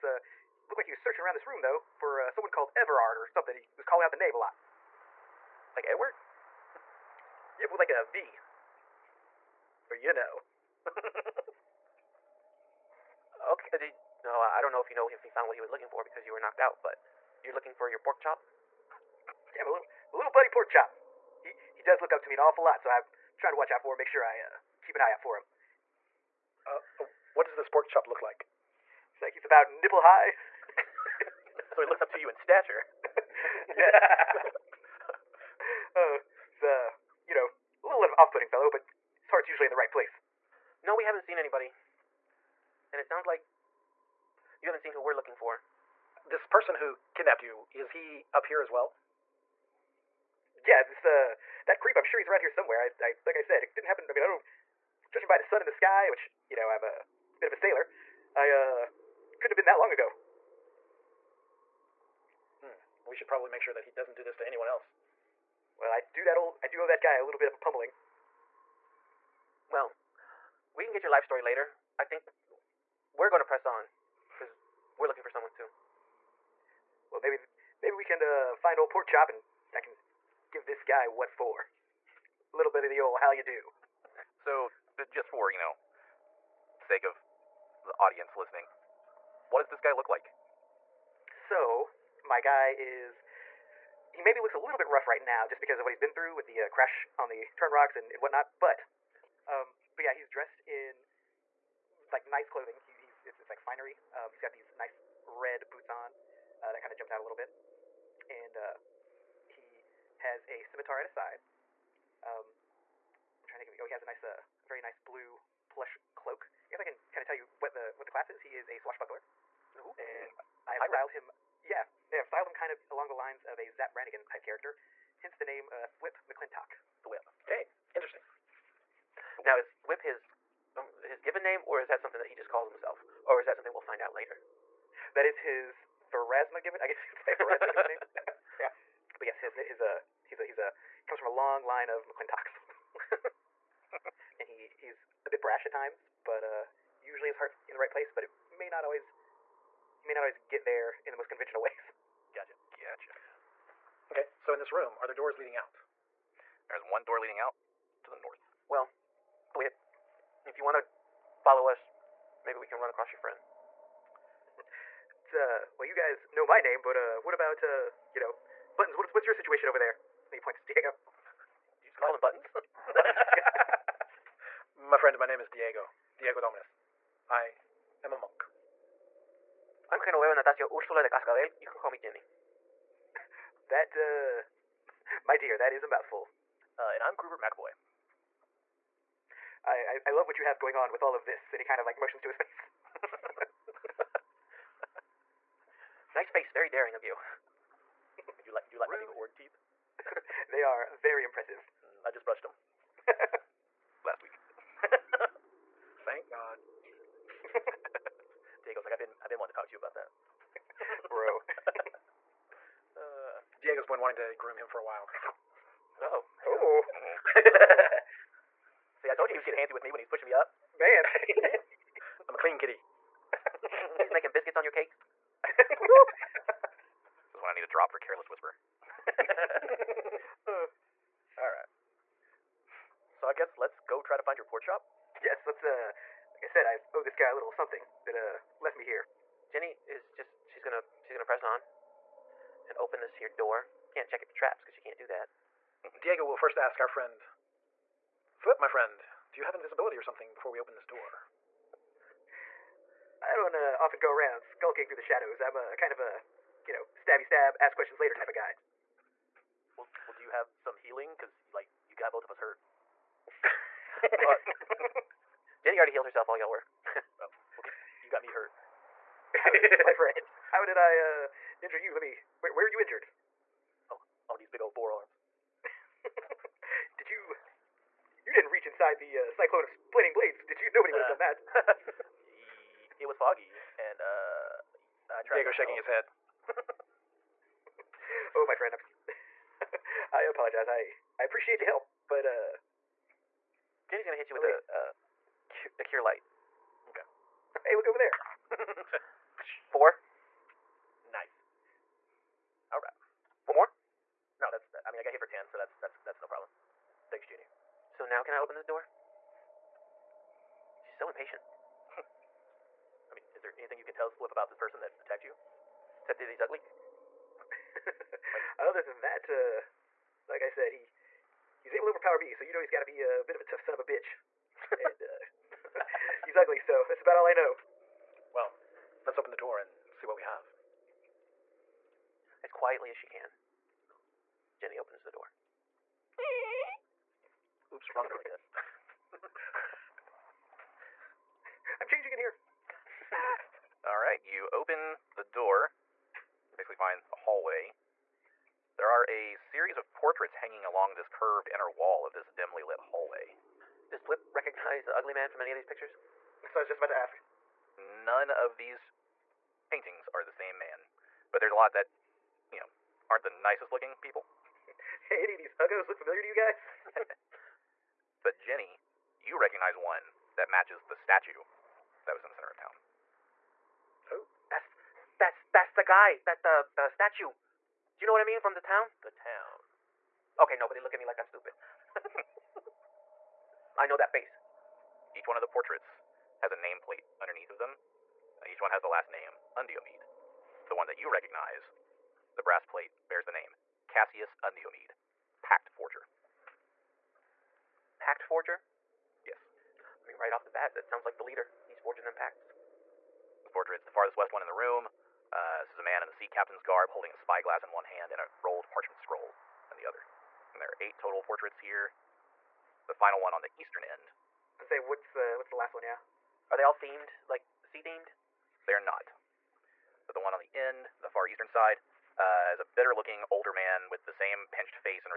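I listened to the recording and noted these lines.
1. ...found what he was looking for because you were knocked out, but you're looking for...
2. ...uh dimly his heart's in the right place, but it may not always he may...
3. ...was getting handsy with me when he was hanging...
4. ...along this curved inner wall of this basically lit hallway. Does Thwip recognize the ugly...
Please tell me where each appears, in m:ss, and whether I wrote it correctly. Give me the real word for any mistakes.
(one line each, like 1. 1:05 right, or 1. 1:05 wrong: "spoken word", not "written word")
1. 0:15 right
2. 2:26 wrong: "usually", not "dimly"
3. 3:39 wrong: "pushing", not "hanging"
4. 5:50 wrong: "dimly", not "basically".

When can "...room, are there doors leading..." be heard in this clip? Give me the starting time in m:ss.
2:34.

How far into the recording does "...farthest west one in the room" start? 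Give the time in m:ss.
6:43.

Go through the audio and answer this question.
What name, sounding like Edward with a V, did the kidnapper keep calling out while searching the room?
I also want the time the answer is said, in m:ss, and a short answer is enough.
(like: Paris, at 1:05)
Everard, at 0:02.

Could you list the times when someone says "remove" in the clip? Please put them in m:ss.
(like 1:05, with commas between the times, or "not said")
not said.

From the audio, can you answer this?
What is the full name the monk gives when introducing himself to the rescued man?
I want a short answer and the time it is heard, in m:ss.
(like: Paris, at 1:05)
Diego Dominus, at 2:56.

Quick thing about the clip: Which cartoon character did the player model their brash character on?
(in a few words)
Zap Brannigan.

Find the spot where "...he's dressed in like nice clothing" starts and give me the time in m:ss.
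1:40.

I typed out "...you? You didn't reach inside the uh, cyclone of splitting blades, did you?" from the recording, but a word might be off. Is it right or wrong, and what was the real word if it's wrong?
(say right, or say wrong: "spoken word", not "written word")
right.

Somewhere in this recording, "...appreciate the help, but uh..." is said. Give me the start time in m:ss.
4:51.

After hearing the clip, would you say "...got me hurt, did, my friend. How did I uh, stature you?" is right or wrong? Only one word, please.
wrong.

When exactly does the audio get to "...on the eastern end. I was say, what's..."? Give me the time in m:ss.
6:53.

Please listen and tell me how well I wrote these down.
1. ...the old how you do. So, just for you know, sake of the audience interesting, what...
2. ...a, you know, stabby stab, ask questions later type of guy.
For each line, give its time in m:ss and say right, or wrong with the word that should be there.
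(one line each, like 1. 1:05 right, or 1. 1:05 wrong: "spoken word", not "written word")
1. 1:22 wrong: "listening", not "interesting"
2. 4:15 right.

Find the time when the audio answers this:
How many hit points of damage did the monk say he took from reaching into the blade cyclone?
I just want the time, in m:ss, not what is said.
5:05.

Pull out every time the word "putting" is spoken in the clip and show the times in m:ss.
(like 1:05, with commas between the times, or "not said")
0:38.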